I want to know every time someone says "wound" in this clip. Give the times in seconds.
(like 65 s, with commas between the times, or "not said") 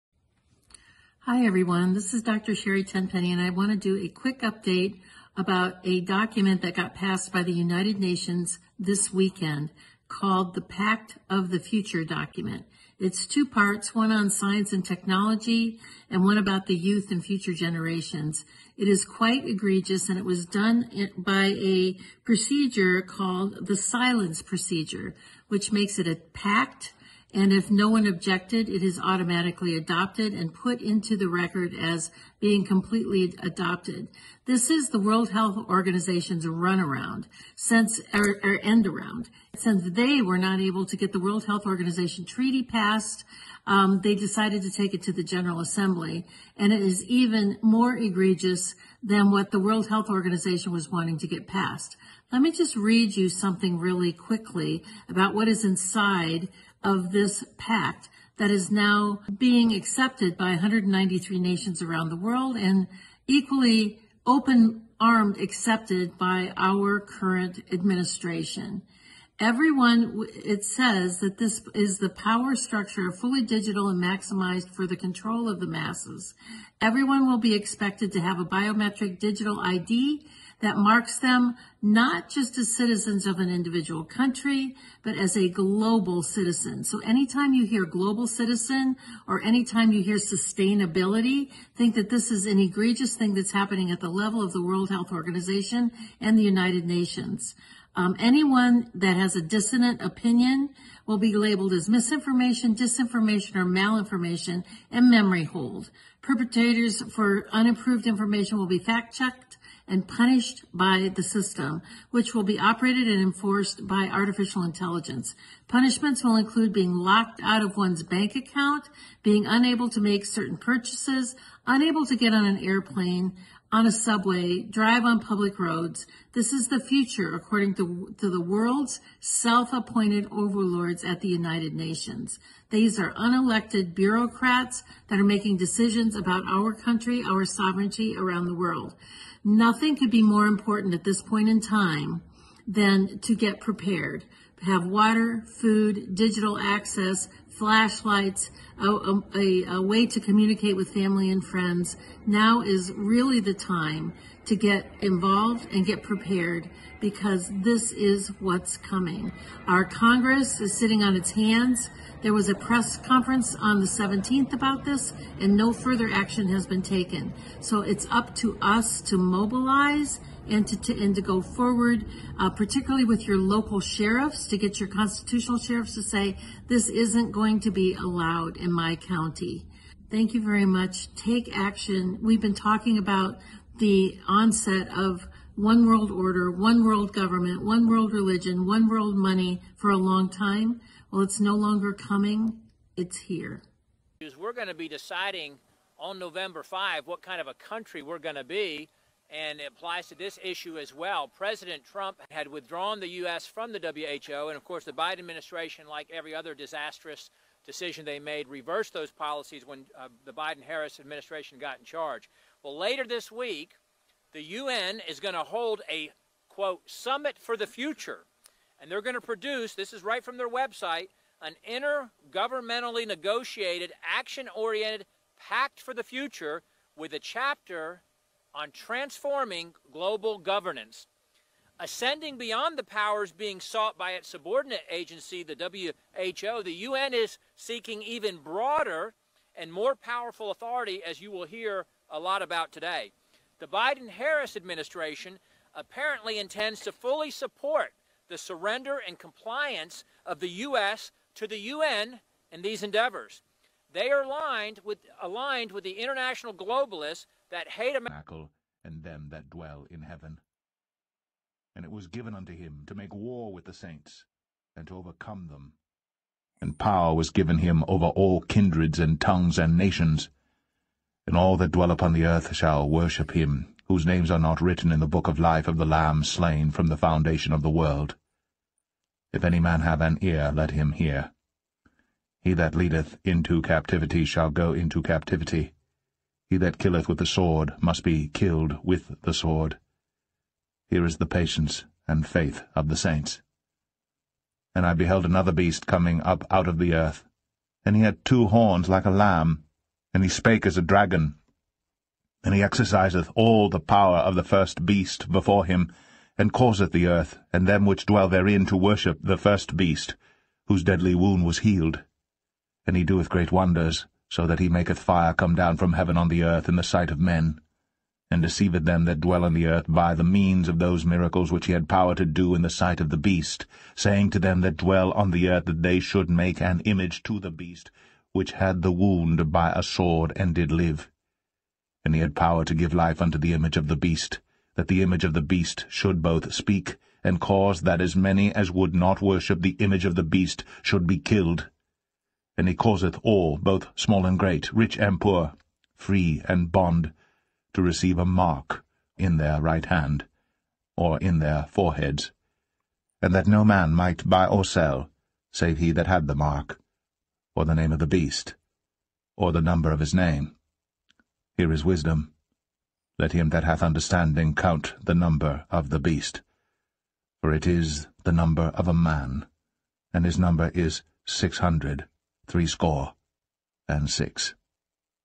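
311 s, 328 s.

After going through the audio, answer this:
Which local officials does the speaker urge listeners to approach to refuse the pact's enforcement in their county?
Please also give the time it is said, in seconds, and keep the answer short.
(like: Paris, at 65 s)
constitutional sheriffs, at 174 s.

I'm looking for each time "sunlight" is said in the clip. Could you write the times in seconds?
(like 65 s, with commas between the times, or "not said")
not said.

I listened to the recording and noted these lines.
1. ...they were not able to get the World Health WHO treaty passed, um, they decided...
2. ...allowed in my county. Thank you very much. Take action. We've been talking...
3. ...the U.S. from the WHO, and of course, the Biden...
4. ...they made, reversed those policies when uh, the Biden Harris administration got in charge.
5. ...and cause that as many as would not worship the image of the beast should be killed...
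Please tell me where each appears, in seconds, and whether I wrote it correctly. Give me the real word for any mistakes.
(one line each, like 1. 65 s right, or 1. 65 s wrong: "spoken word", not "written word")
1. 39 s wrong: "Organization", not "WHO"
2. 177 s right
3. 202 s right
4. 208 s right
5. 337 s right.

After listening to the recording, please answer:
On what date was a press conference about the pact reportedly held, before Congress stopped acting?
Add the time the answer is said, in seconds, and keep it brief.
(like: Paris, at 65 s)
the 17th, at 163 s.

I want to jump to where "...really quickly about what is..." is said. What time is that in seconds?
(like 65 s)
53 s.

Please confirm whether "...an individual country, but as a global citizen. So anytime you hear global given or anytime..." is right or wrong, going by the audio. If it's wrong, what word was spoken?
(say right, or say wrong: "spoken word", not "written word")
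wrong: "citizen", not "given".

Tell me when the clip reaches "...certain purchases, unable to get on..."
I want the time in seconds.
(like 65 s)
120 s.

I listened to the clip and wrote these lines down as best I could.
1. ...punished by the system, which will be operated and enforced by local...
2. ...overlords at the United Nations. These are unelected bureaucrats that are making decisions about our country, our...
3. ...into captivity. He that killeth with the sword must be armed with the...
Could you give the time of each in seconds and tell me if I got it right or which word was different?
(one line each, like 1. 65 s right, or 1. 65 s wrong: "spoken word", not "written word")
1. 110 s wrong: "artificial", not "local"
2. 130 s right
3. 284 s wrong: "killed", not "armed".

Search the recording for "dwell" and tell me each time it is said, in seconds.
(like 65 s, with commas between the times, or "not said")
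259 s, 271 s, 308 s, 319 s, 324 s.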